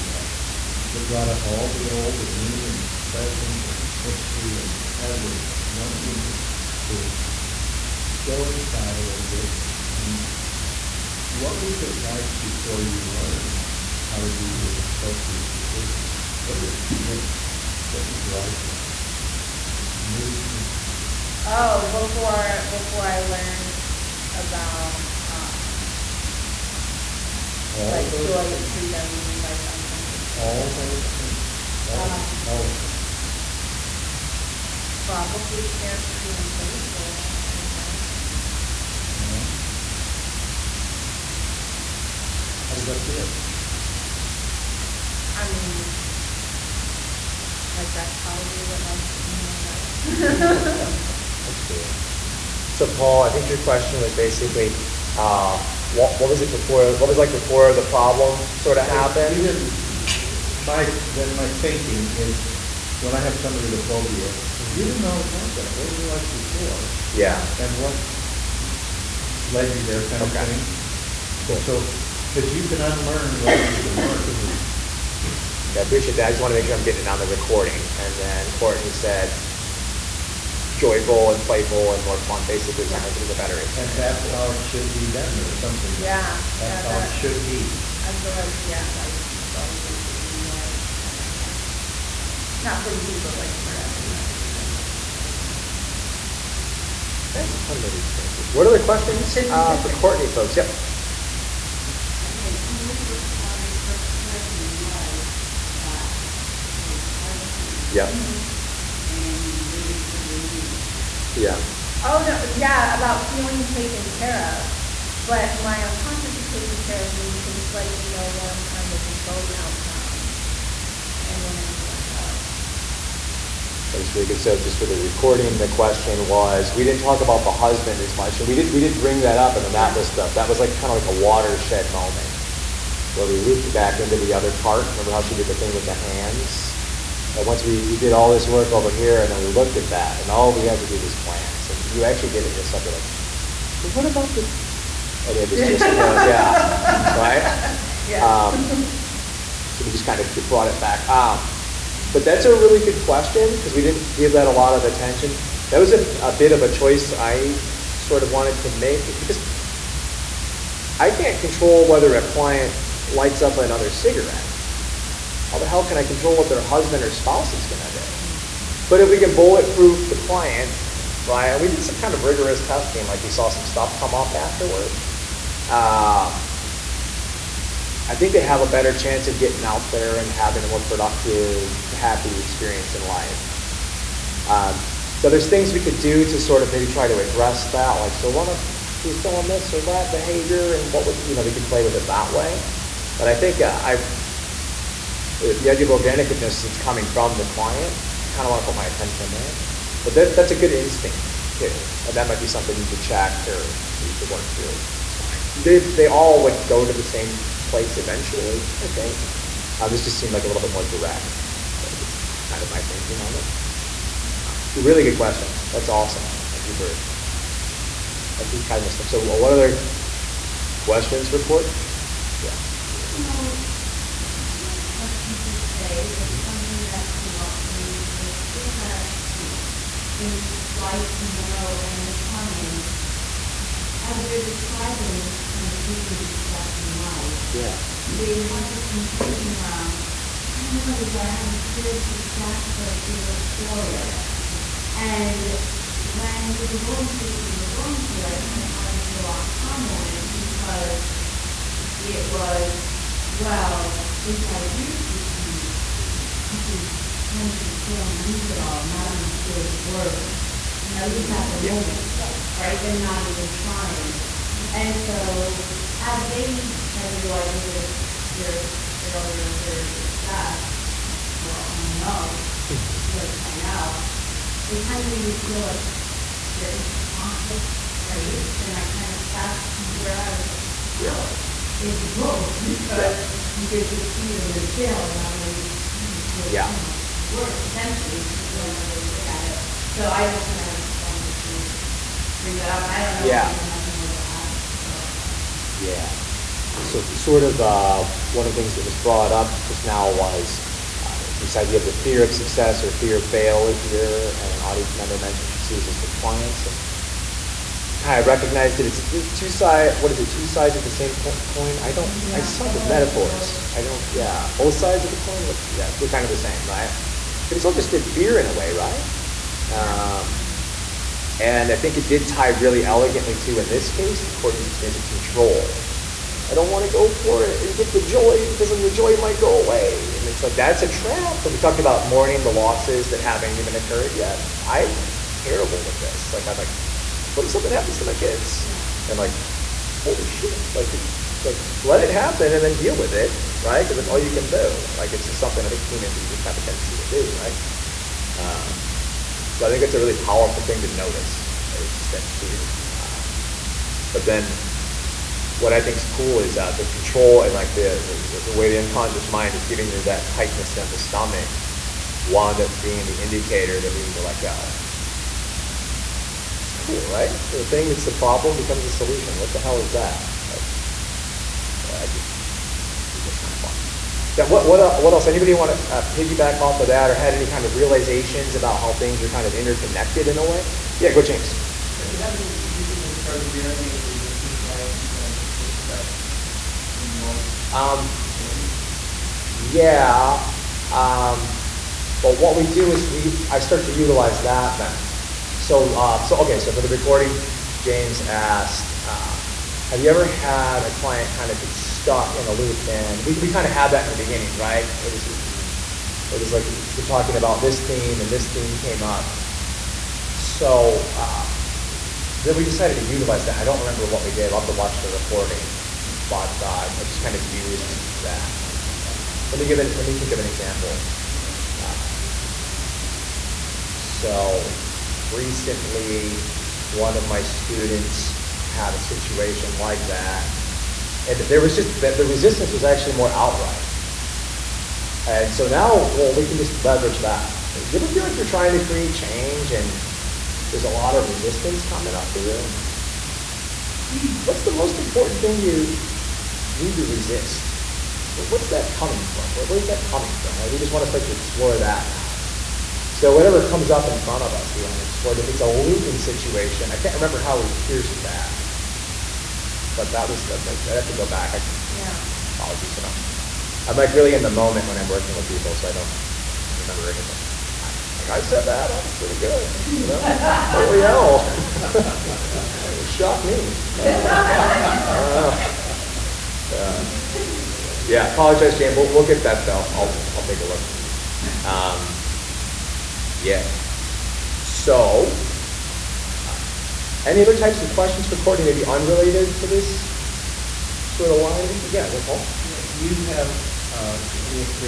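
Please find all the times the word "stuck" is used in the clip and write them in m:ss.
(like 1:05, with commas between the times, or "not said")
6:25, 6:41.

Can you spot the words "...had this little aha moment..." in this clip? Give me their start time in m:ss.
4:08.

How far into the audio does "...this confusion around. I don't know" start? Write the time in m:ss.
3:58.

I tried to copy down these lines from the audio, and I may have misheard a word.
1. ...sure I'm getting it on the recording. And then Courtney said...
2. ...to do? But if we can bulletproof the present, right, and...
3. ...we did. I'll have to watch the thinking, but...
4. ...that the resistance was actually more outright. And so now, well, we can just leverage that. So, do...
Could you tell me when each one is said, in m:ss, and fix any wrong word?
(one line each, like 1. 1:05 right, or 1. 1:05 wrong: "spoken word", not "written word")
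1. 1:16 right
2. 2:47 wrong: "client", not "present"
3. 6:54 wrong: "recording", not "thinking"
4. 7:11 right.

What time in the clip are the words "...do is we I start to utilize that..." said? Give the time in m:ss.
6:32.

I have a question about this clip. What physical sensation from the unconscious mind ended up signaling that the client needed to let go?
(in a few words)
tightness in the stomach.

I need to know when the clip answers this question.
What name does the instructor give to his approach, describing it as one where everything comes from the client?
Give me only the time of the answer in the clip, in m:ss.
3:15.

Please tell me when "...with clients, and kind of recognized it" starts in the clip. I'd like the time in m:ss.
5:05.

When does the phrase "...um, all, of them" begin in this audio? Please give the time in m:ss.
0:31.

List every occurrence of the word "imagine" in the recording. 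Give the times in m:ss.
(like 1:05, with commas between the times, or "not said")
0:37.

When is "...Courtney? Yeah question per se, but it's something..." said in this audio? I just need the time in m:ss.
3:41.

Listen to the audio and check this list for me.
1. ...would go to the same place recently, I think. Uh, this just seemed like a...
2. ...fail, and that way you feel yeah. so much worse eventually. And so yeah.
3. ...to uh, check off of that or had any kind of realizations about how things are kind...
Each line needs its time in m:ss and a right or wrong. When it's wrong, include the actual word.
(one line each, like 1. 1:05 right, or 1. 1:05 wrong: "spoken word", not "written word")
1. 3:26 wrong: "eventually", not "recently"
2. 4:44 wrong: "potentially", not "eventually"
3. 6:15 wrong: "piggyback", not "check".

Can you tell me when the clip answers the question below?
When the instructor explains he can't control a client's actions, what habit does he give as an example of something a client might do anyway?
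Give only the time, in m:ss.
2:43.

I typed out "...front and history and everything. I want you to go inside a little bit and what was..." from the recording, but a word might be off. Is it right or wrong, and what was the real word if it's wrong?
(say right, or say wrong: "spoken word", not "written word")
wrong: "present", not "front".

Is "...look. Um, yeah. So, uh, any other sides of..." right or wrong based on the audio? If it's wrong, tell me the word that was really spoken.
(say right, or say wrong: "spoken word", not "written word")
wrong: "types", not "sides".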